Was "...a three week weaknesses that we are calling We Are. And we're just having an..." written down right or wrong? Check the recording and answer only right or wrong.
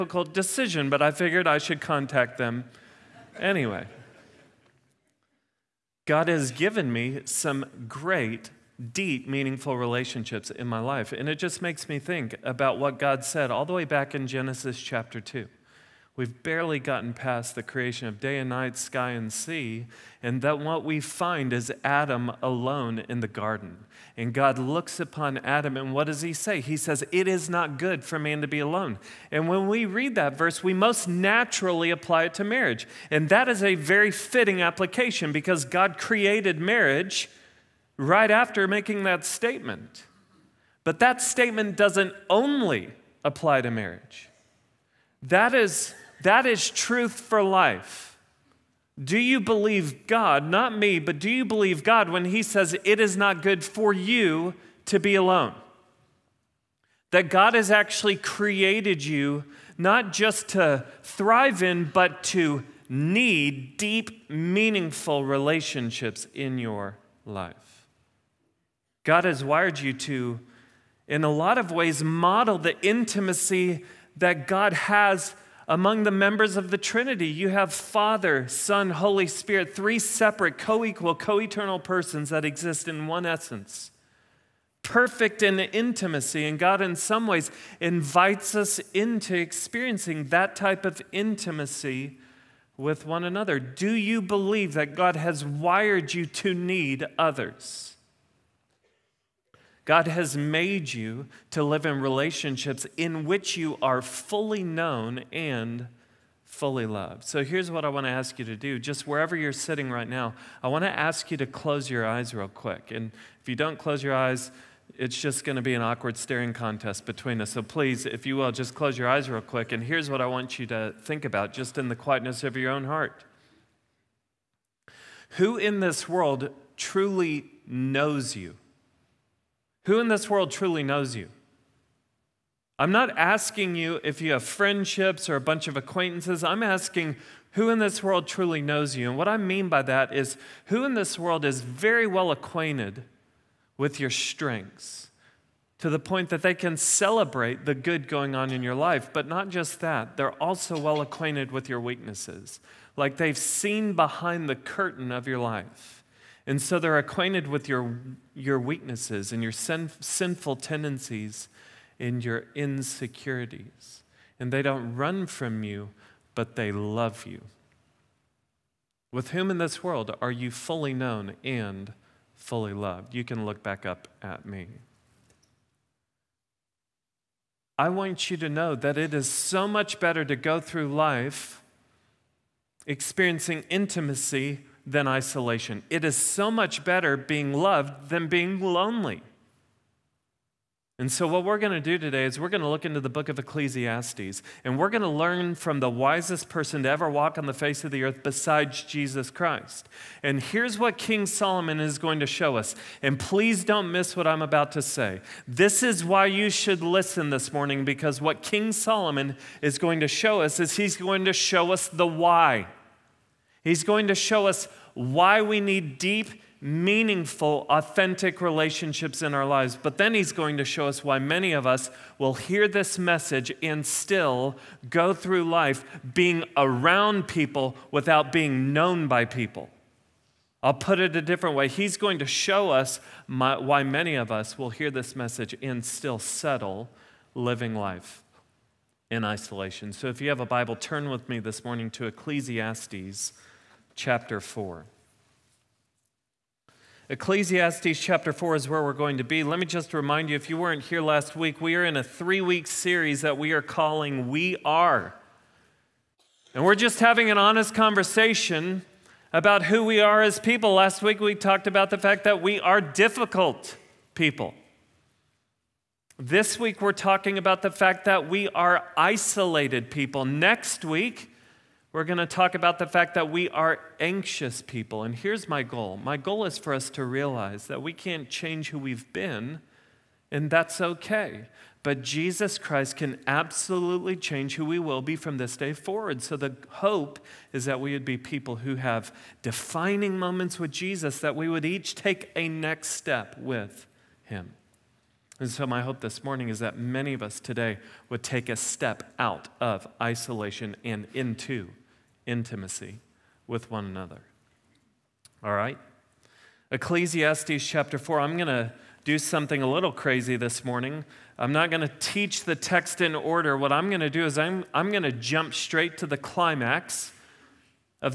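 wrong.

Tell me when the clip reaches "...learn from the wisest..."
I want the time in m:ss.
3:15.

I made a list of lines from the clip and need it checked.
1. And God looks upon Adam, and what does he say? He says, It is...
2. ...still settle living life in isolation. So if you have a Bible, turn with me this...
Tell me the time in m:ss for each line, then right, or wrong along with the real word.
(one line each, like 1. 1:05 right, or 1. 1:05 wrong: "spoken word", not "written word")
1. 0:24 right
2. 3:55 right.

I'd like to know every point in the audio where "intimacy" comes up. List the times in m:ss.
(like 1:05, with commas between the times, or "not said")
1:12, 1:25, 1:31, 3:03, 5:02.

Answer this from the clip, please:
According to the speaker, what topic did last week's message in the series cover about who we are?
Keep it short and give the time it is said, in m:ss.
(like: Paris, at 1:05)
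Difficult people, at 4:22.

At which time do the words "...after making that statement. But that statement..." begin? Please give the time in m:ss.
0:38.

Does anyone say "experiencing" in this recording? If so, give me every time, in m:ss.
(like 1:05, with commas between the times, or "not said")
1:29, 3:02.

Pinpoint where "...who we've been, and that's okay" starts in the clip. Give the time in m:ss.
4:38.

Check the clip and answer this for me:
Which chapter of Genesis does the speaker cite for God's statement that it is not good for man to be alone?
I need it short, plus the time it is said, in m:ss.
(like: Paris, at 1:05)
Chapter 2, at 0:14.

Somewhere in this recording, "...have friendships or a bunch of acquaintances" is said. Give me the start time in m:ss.
2:14.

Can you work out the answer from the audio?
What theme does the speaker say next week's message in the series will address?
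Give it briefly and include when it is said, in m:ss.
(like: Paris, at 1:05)
Anxious people, at 4:33.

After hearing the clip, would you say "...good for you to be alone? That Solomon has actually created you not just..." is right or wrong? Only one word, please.
wrong.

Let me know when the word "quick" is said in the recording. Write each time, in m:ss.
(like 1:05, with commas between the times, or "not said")
1:52, 1:59.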